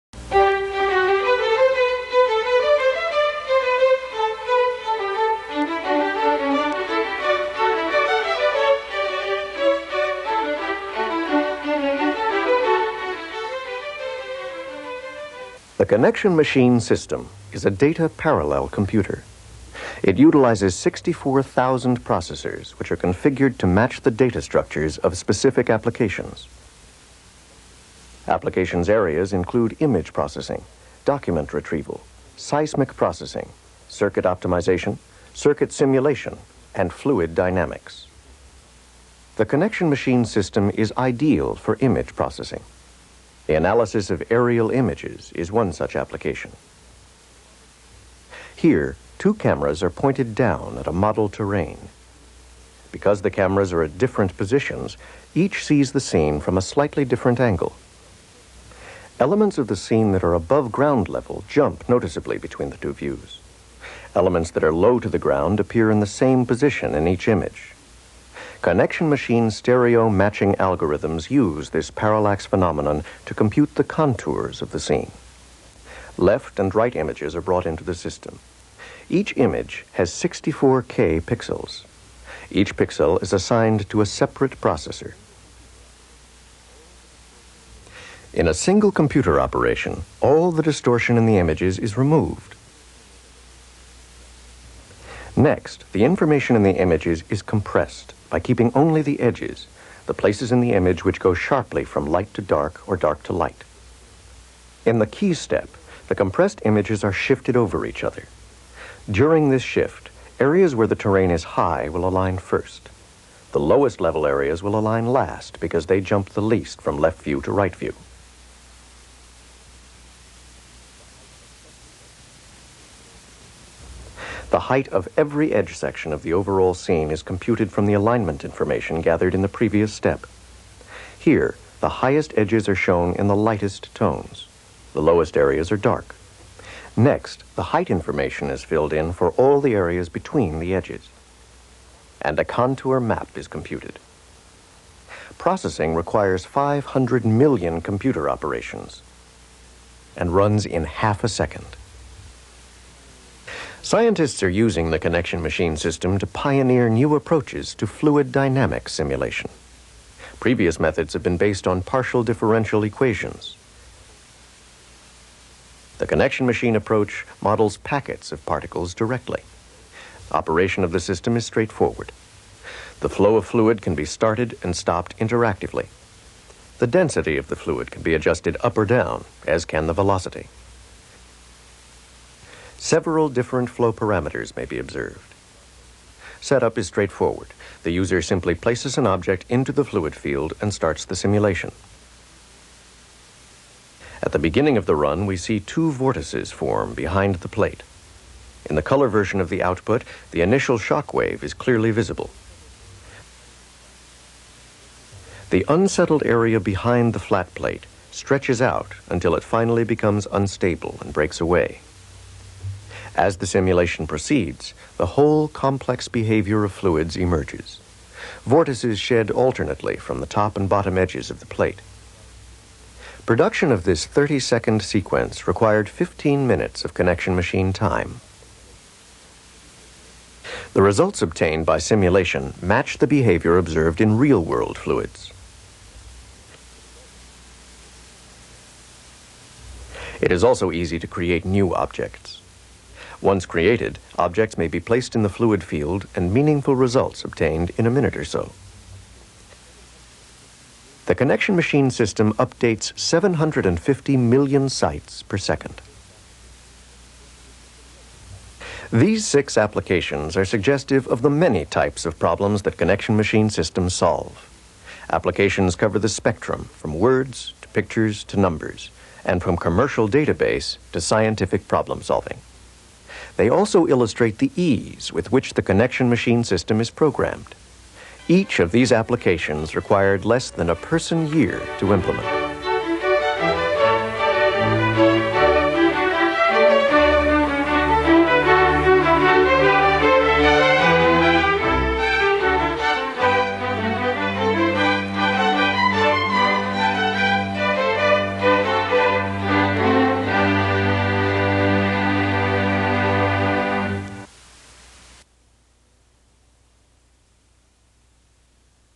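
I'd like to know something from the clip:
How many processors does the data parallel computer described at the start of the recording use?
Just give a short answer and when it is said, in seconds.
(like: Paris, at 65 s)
64,000, at 20 s.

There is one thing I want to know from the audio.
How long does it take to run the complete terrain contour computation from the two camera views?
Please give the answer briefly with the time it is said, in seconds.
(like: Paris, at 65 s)
half a second, at 150 s.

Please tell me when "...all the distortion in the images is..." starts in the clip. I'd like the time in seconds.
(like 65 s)
90 s.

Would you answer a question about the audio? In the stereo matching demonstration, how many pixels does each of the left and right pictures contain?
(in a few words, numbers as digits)
64K.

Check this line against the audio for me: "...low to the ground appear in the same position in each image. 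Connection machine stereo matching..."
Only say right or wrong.
right.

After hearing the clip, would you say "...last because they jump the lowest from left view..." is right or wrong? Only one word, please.
wrong.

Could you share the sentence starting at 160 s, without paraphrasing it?
Previous methods have been based on partial differential equations.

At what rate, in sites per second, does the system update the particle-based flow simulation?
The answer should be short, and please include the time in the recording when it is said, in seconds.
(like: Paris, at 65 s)
750 million, at 252 s.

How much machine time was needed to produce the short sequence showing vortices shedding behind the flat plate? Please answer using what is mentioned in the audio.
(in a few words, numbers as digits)
15 minutes.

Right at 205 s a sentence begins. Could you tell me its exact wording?
The unsettled area behind the flat plate stretches out until it finally becomes unstable and breaks away.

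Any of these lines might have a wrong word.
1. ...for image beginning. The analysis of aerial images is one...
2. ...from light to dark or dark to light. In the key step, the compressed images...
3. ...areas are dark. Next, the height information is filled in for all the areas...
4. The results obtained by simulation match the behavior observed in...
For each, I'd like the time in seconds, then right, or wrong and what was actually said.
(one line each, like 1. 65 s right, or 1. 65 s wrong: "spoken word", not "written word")
1. 41 s wrong: "processing", not "beginning"
2. 101 s right
3. 135 s right
4. 230 s right.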